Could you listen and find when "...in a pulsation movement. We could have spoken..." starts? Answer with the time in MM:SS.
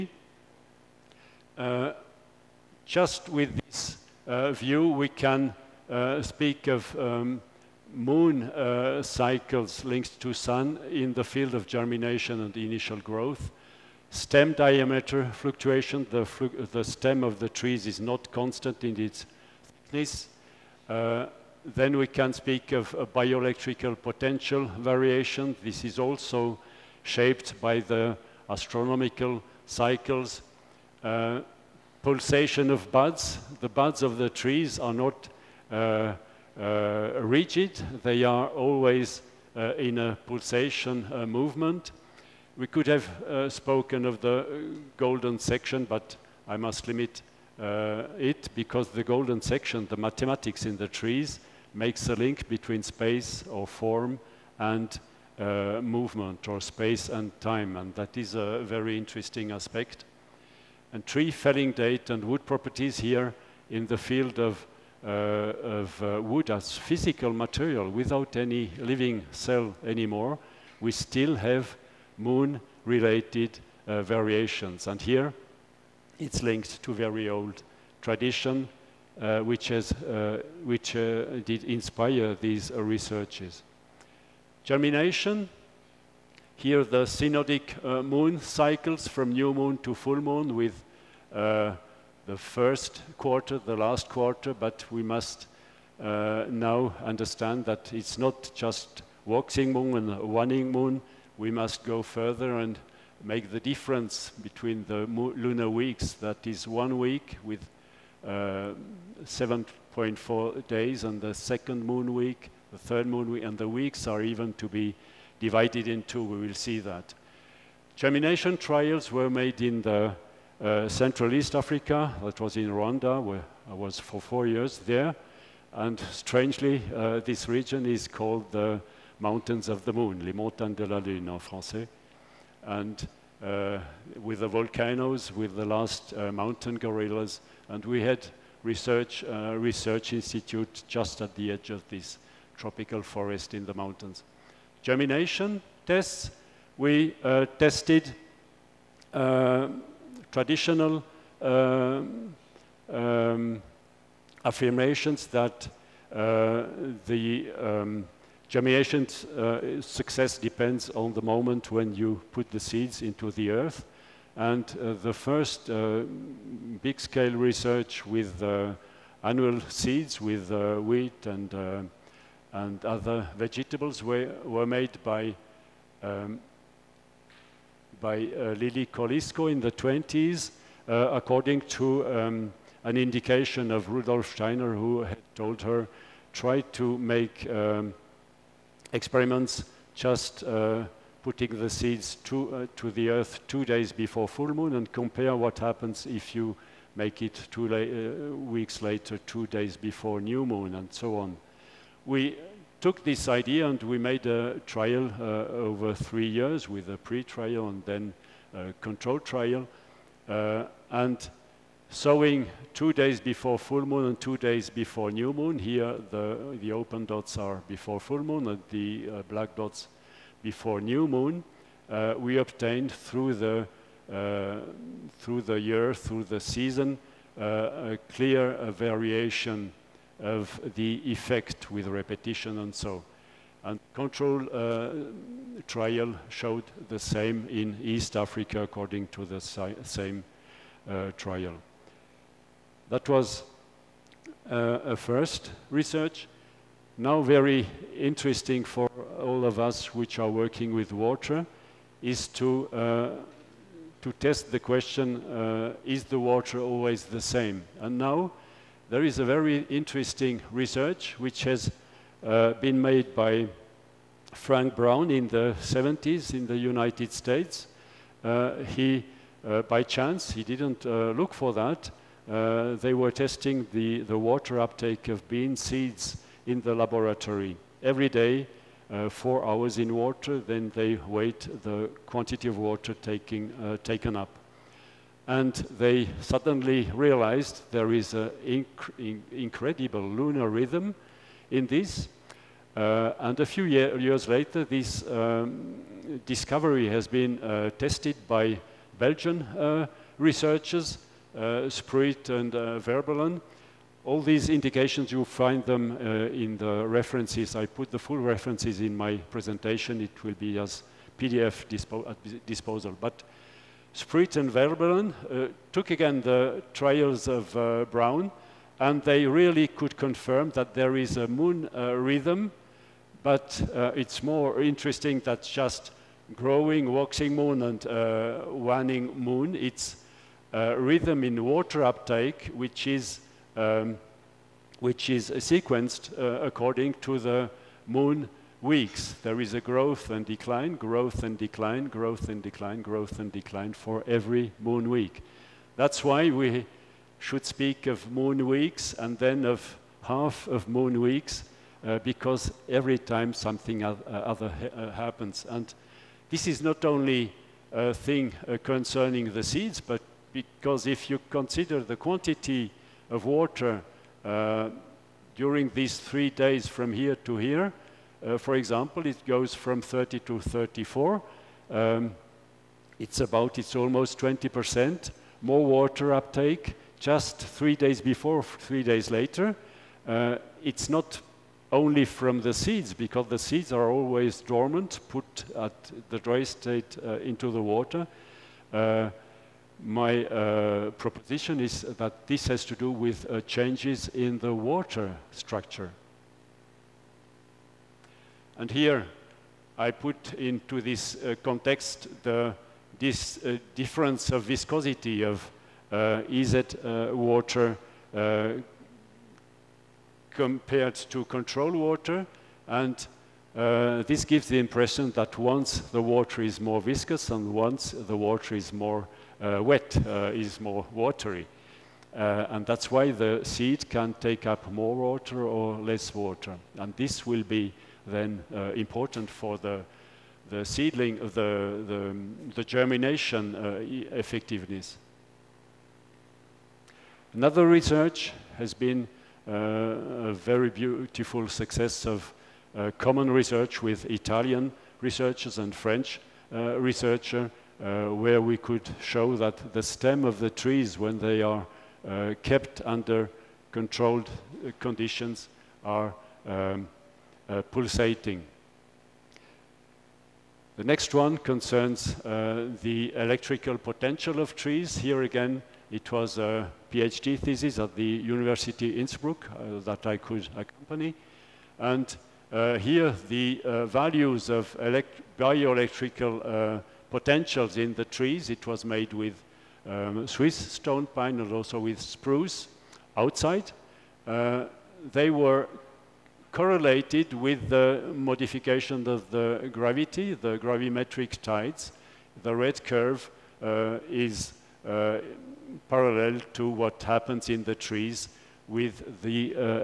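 00:39.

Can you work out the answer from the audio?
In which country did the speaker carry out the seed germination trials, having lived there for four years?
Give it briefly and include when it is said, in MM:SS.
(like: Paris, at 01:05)
Rwanda, at 02:02.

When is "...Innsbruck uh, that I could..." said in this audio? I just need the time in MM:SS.
07:48.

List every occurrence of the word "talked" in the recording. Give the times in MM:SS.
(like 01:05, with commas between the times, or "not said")
not said.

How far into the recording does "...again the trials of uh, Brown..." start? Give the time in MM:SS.
05:15.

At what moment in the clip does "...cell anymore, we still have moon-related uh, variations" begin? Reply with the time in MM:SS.
01:09.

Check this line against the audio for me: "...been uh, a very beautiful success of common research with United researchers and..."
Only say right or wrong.
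wrong.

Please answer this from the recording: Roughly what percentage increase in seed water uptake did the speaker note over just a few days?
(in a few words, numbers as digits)
20%.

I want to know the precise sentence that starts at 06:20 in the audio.
Uh, it's not only from the seeds, because the seeds are always dormant, put at the dry state uh, into the water.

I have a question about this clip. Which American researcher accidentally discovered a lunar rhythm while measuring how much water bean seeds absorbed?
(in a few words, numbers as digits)
Frank Brown.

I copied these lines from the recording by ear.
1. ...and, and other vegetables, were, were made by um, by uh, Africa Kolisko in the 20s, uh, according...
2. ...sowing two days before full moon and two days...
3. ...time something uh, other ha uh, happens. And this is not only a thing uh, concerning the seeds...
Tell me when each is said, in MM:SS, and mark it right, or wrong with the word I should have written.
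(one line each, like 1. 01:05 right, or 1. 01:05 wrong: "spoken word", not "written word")
1. 02:51 wrong: "Lili", not "Africa"
2. 03:31 right
3. 05:52 right.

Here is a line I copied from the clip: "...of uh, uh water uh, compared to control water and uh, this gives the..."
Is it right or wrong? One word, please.
right.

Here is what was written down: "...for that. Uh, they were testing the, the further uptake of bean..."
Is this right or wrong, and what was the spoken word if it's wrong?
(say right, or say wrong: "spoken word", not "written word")
wrong: "water", not "further".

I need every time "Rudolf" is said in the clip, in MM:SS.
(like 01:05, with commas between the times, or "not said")
03:03.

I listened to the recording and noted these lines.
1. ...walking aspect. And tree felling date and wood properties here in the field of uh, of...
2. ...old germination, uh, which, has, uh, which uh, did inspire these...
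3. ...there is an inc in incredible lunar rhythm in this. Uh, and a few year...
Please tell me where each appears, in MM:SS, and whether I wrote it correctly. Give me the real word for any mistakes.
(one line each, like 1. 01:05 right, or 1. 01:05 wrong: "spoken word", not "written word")
1. 00:58 wrong: "interesting", not "walking"
2. 01:17 wrong: "tradition", not "germination"
3. 04:47 right.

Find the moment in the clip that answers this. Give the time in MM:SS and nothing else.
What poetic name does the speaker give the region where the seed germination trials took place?
02:09.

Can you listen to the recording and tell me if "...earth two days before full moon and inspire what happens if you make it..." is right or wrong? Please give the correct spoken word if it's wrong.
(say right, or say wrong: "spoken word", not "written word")
wrong: "compare", not "inspire".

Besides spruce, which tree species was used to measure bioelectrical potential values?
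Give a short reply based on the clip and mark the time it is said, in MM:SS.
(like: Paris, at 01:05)
Swiss stone pine, at 08:00.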